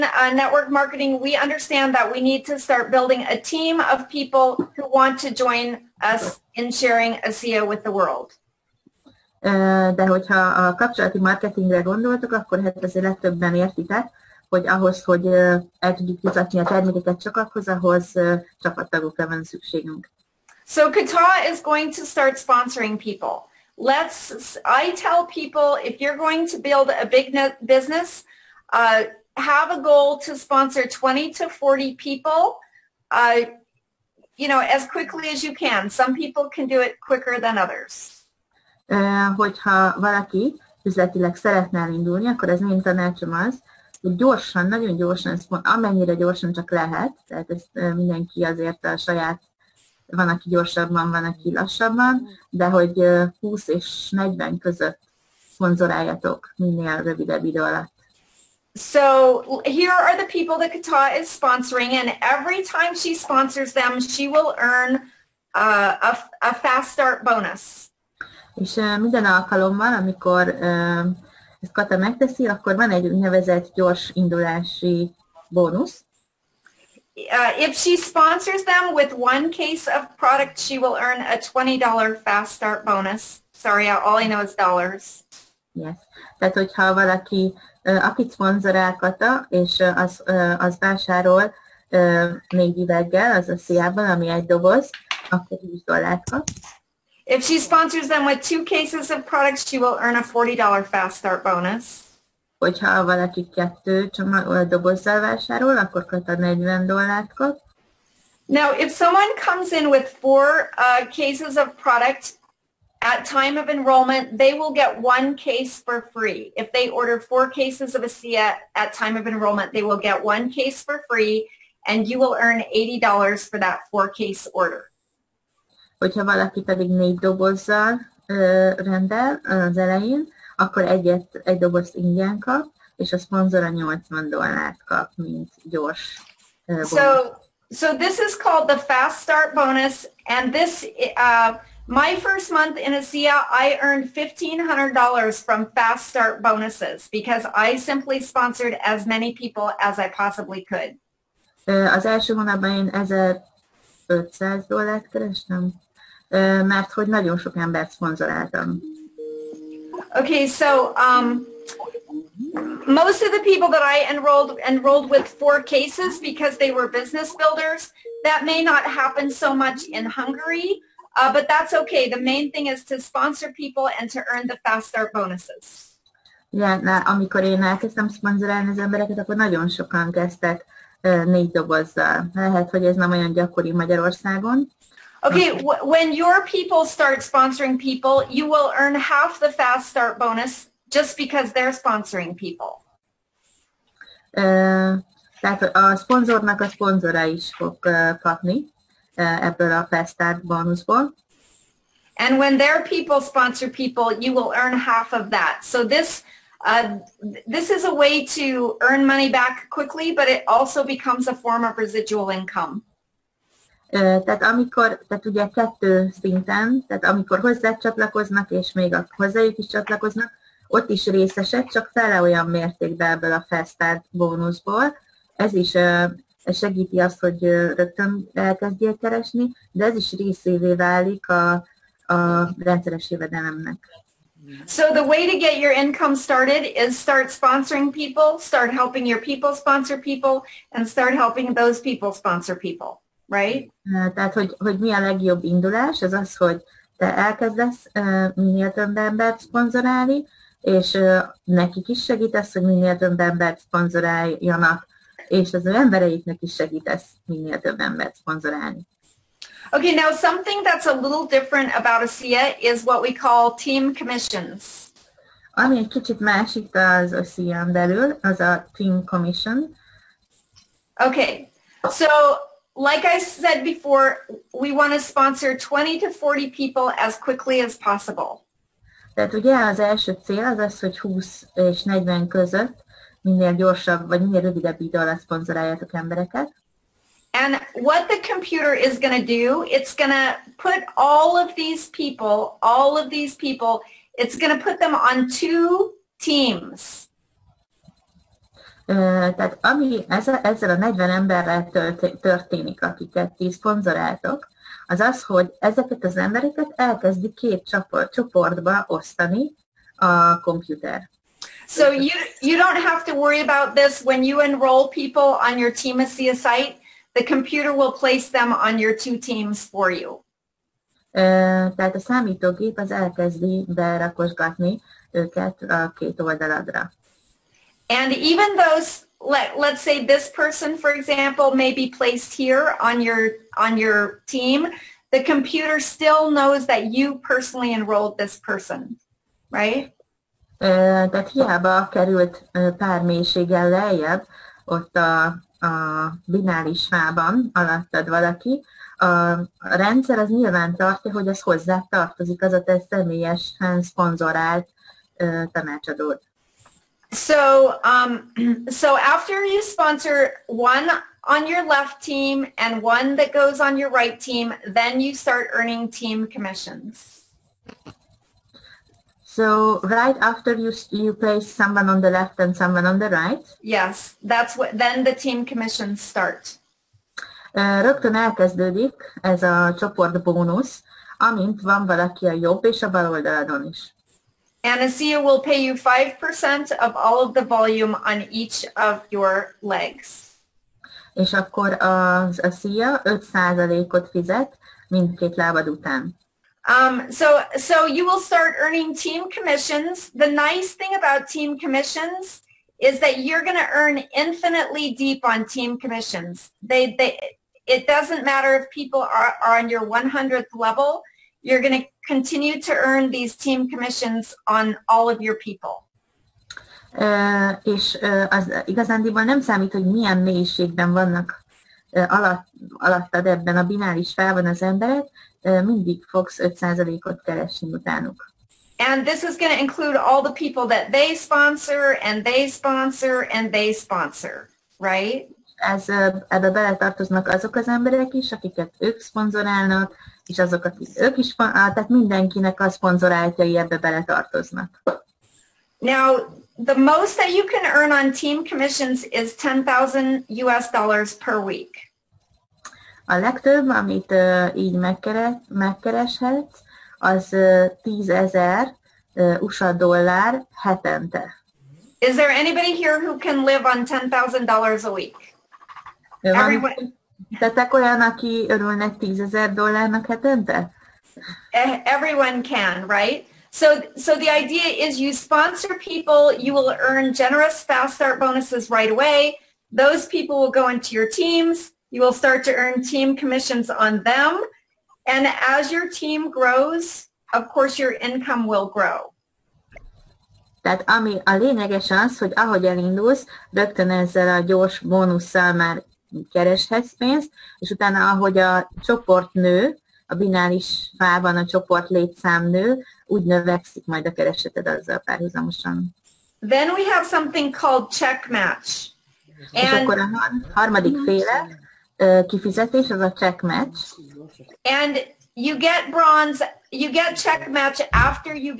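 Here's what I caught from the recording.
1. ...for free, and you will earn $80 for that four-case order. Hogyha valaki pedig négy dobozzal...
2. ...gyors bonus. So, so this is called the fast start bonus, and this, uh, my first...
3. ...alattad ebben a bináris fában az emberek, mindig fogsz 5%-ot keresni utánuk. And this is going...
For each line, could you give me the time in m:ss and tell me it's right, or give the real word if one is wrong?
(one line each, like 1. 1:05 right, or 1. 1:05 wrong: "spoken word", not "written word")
1. 2:00 right
2. 2:15 right
3. 7:02 right.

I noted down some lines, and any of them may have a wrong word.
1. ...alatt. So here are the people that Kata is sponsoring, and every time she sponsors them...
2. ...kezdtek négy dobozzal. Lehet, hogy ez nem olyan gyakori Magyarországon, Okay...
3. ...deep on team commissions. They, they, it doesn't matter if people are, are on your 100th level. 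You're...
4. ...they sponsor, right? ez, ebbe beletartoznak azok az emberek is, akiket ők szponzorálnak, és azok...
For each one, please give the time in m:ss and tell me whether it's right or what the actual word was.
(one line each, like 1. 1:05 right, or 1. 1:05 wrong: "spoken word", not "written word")
1. 0:57 right
2. 3:00 right
3. 6:44 right
4. 7:13 right.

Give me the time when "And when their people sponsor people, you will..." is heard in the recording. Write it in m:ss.
3:22.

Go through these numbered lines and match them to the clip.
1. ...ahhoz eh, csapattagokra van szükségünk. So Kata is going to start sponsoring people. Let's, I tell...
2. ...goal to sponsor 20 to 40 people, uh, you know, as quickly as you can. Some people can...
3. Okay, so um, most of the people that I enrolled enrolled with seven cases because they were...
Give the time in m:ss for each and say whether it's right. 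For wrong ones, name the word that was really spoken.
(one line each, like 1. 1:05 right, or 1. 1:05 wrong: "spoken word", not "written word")
1. 0:17 right
2. 0:29 right
3. 2:40 wrong: "four", not "seven".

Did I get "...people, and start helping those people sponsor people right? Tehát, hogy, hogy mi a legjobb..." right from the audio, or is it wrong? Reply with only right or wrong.
right.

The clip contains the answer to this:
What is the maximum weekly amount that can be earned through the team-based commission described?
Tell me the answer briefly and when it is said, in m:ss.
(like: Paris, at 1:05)
10,000 US dollars, at 7:29.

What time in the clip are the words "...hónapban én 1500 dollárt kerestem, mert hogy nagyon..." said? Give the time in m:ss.
2:32.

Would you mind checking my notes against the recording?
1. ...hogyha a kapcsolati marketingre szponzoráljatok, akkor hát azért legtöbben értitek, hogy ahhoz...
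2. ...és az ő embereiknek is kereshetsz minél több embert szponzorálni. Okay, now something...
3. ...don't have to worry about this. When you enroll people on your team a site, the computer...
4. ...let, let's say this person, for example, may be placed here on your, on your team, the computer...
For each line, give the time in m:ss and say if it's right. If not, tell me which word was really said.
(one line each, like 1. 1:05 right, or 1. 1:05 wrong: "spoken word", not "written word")
1. 0:10 wrong: "gondoltok", not "szponzoráljatok"
2. 4:15 wrong: "segítesz", not "kereshetsz"
3. 5:12 right
4. 5:29 right.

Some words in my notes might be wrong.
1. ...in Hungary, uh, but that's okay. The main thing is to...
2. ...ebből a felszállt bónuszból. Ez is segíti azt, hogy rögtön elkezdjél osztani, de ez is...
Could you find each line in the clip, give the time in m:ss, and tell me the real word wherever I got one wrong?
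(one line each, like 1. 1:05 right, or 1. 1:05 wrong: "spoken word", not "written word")
1. 2:49 right
2. 3:43 wrong: "keresni", not "osztani".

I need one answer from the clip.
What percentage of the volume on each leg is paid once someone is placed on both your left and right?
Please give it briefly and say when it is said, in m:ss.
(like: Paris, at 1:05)
5%, at 6:25.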